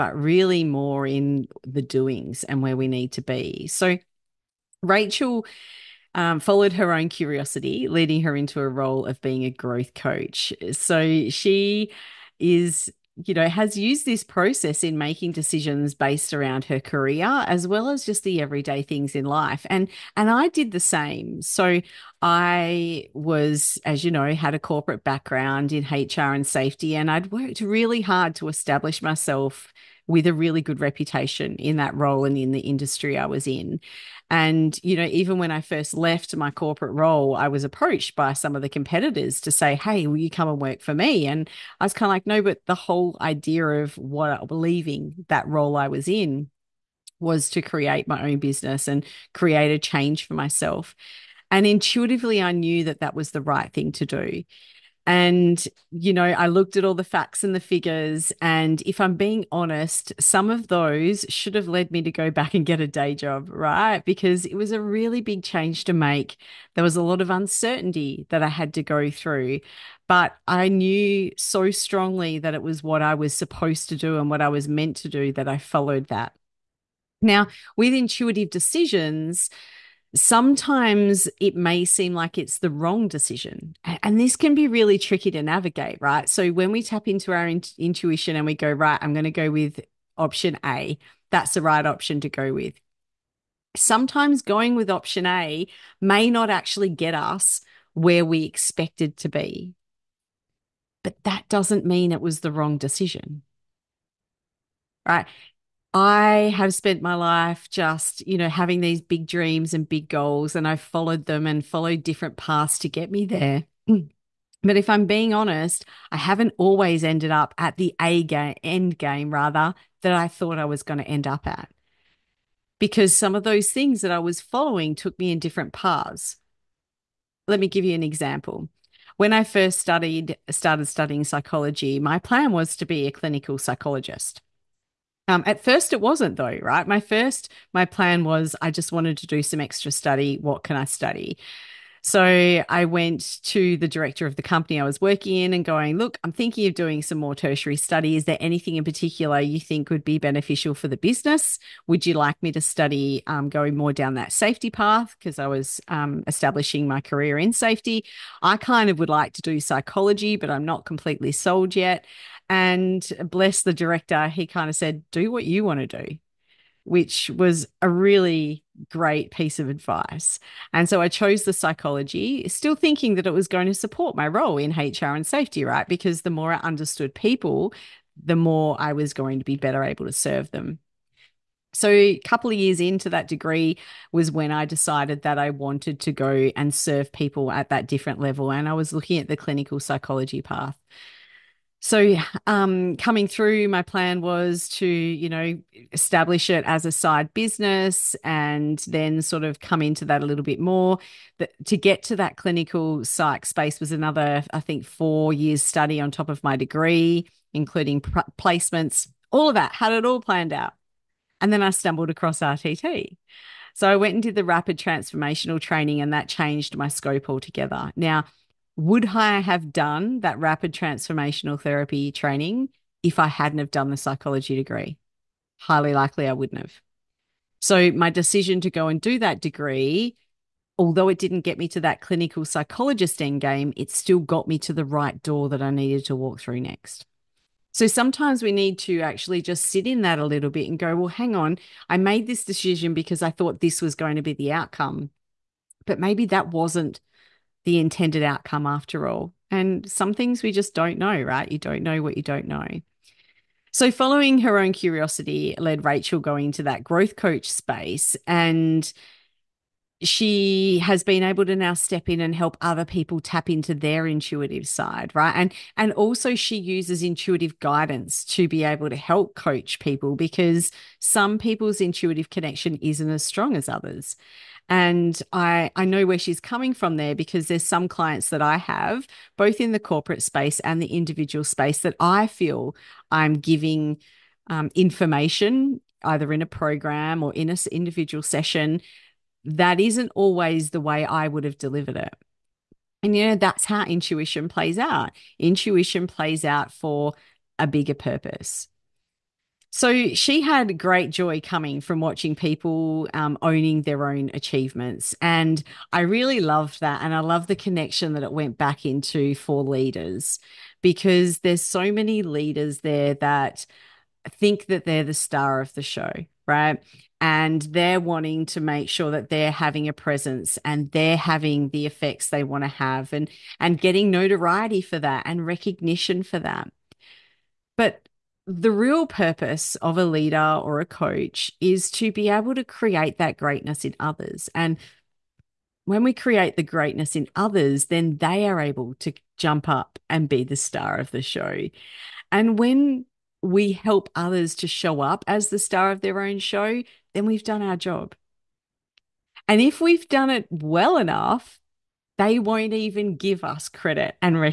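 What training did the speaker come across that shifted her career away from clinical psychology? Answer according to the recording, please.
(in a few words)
Rapid Transformational Therapy.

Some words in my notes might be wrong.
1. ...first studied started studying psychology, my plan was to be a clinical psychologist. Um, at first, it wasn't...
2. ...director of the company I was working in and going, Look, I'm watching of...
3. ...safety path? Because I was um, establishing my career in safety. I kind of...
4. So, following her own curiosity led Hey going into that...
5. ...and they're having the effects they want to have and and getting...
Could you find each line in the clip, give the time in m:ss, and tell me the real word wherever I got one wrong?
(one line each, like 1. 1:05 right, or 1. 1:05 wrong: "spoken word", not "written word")
1. 2:09 right
2. 2:23 wrong: "thinking", not "watching"
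3. 2:34 right
4. 4:13 wrong: "Rachel", not "Hey"
5. 5:20 right.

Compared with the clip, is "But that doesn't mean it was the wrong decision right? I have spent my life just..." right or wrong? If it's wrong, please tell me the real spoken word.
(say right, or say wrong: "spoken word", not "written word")
right.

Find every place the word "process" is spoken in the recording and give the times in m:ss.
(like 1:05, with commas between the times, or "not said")
0:14.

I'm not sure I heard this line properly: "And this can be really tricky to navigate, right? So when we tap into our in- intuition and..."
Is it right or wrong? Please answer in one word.
right.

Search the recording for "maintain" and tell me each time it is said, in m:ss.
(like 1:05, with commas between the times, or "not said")
not said.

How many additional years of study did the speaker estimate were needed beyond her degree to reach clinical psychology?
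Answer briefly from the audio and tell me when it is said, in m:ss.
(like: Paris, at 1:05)
4, at 3:24.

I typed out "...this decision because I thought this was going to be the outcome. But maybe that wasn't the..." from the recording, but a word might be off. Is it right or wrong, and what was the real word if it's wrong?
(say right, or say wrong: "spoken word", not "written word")
right.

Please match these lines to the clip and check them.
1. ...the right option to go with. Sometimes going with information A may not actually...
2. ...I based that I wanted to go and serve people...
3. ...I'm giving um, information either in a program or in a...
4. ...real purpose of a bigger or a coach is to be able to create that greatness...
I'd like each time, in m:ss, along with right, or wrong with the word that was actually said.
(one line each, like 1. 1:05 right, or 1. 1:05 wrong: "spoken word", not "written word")
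1. 1:31 wrong: "option", not "information"
2. 3:04 wrong: "decided", not "based"
3. 4:43 right
4. 5:28 wrong: "leader", not "bigger".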